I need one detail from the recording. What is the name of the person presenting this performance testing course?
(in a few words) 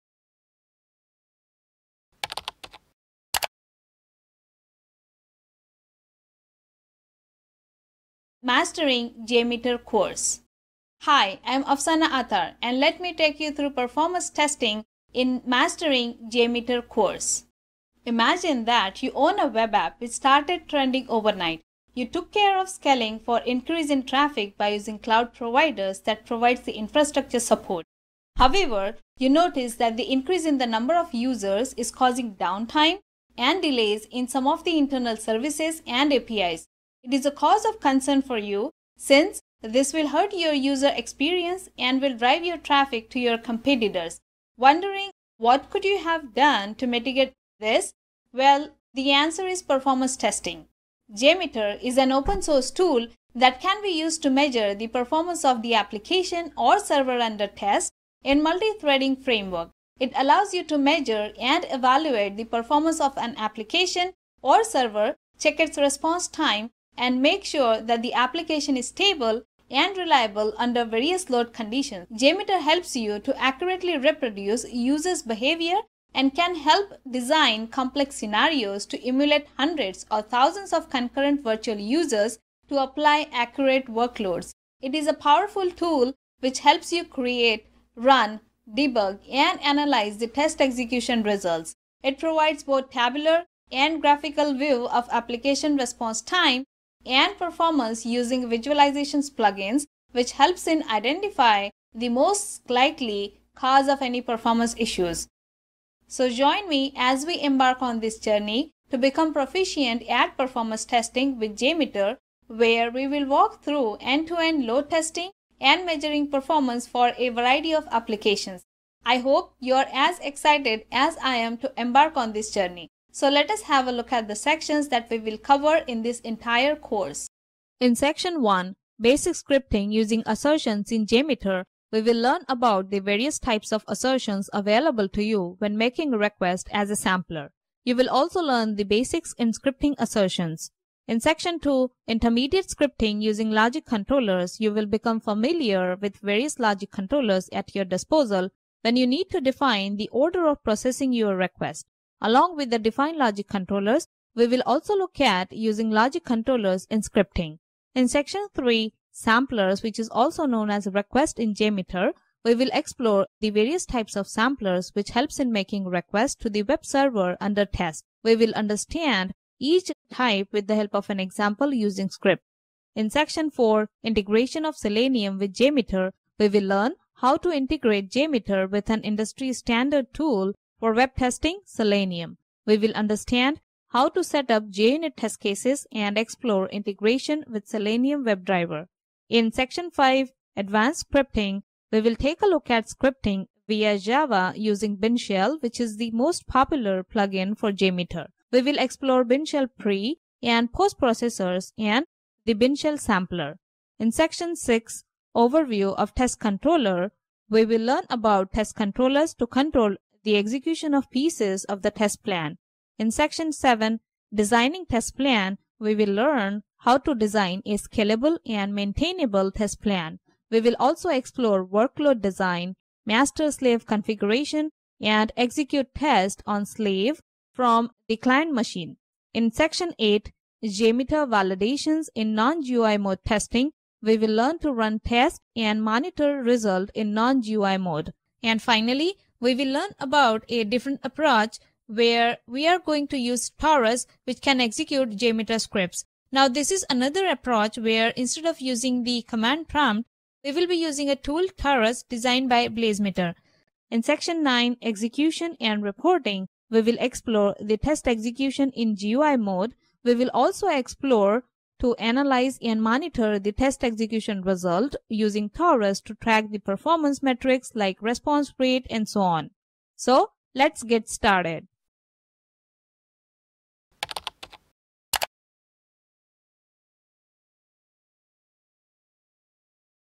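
Afsana Athar.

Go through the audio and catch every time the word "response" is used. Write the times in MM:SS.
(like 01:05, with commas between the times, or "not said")
01:05, 01:35, 04:28.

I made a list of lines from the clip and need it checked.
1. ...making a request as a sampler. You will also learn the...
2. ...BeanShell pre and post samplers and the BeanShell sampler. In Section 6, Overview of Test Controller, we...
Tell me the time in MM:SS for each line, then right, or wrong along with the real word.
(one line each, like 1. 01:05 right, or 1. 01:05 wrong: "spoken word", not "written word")
1. 02:15 right
2. 03:19 wrong: "processors", not "samplers".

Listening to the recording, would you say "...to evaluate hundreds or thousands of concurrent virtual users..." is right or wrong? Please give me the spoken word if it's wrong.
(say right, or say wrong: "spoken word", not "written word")
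wrong: "emulate", not "evaluate".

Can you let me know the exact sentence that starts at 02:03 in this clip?
So let us have a look at the sections that we will cover in this entire course.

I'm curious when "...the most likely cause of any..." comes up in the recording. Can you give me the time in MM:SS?
01:41.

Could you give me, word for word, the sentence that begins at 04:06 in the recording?
Now this is another approach where instead of using the command prompt, we will be using a tool Taurus designed by BlazeMeter.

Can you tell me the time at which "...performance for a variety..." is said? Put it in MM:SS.
01:56.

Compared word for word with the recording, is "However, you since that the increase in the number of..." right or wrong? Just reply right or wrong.
wrong.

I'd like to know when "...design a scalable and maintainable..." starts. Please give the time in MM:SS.
03:37.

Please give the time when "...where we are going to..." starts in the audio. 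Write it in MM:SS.
04:01.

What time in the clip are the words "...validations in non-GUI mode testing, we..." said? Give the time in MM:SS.
03:51.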